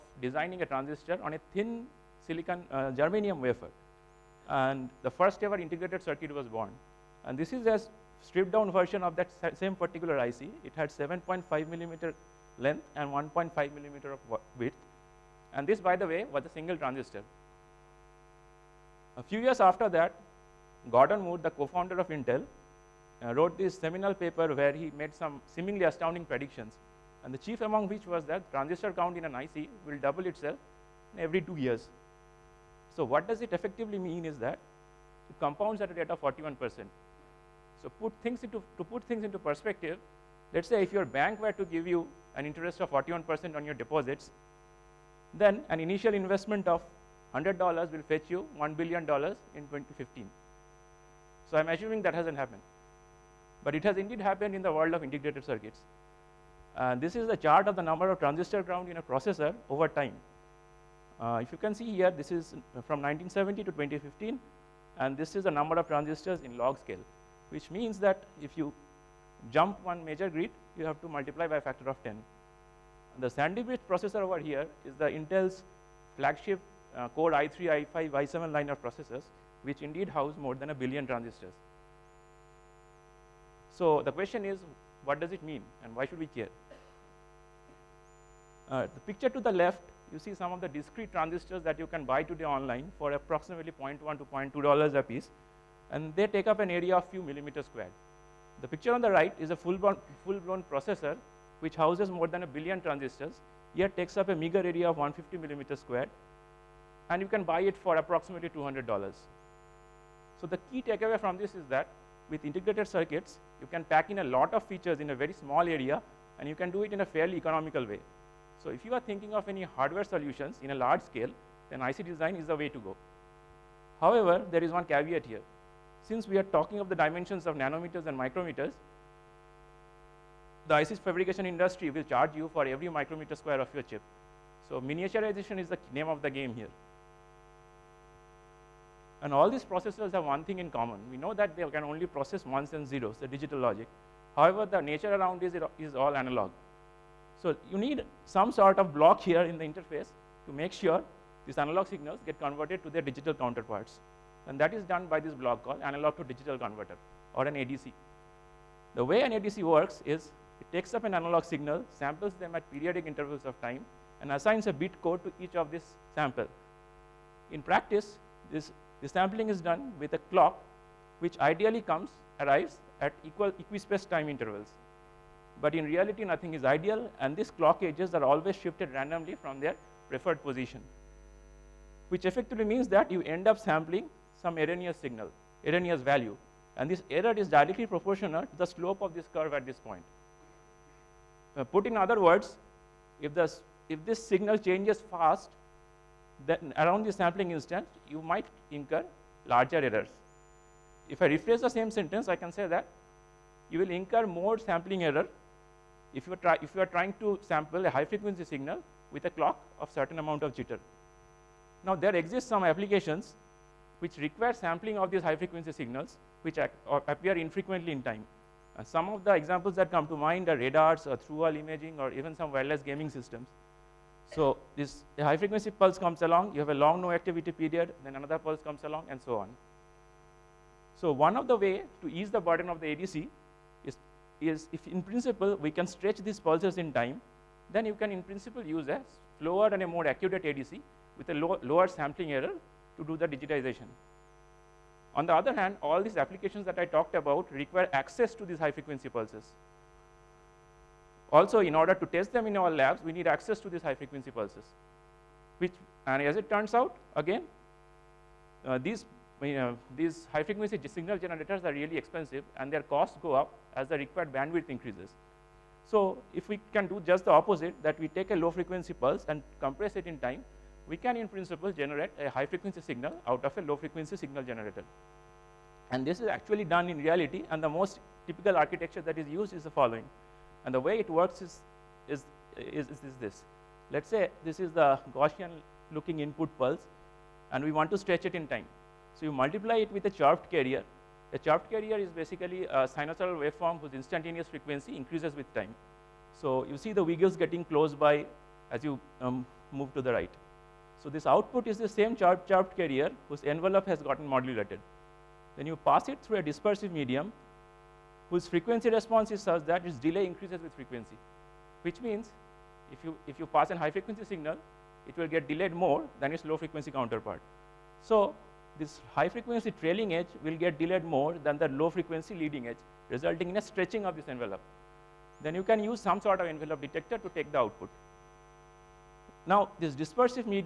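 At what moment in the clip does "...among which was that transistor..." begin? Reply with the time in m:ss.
0:27.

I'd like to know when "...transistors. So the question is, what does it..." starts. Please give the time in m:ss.
1:21.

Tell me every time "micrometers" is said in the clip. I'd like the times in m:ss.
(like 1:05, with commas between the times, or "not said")
2:08, 2:12.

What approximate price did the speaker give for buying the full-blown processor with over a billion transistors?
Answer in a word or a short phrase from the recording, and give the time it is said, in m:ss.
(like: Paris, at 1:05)
$200, at 1:48.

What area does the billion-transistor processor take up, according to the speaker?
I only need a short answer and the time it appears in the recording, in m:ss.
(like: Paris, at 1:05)
150 square millimeters, at 1:45.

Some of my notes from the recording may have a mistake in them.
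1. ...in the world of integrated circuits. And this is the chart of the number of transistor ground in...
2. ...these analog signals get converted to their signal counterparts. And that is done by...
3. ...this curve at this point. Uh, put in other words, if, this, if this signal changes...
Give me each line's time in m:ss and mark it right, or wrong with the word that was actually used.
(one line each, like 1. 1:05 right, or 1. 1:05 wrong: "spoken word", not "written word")
1. 0:54 right
2. 2:31 wrong: "digital", not "signal"
3. 3:09 right.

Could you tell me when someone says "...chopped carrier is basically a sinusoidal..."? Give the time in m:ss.
4:51.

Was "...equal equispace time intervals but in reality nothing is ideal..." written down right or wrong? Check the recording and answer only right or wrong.
right.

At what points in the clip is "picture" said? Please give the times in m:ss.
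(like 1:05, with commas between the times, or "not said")
1:29, 1:38.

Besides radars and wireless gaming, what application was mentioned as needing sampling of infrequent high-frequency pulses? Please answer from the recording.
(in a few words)
through wall imaging.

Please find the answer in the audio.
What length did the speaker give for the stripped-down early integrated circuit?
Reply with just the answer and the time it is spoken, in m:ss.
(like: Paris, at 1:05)
7.5 millimeters, at 0:10.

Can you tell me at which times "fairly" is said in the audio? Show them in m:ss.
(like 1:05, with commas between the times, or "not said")
1:57.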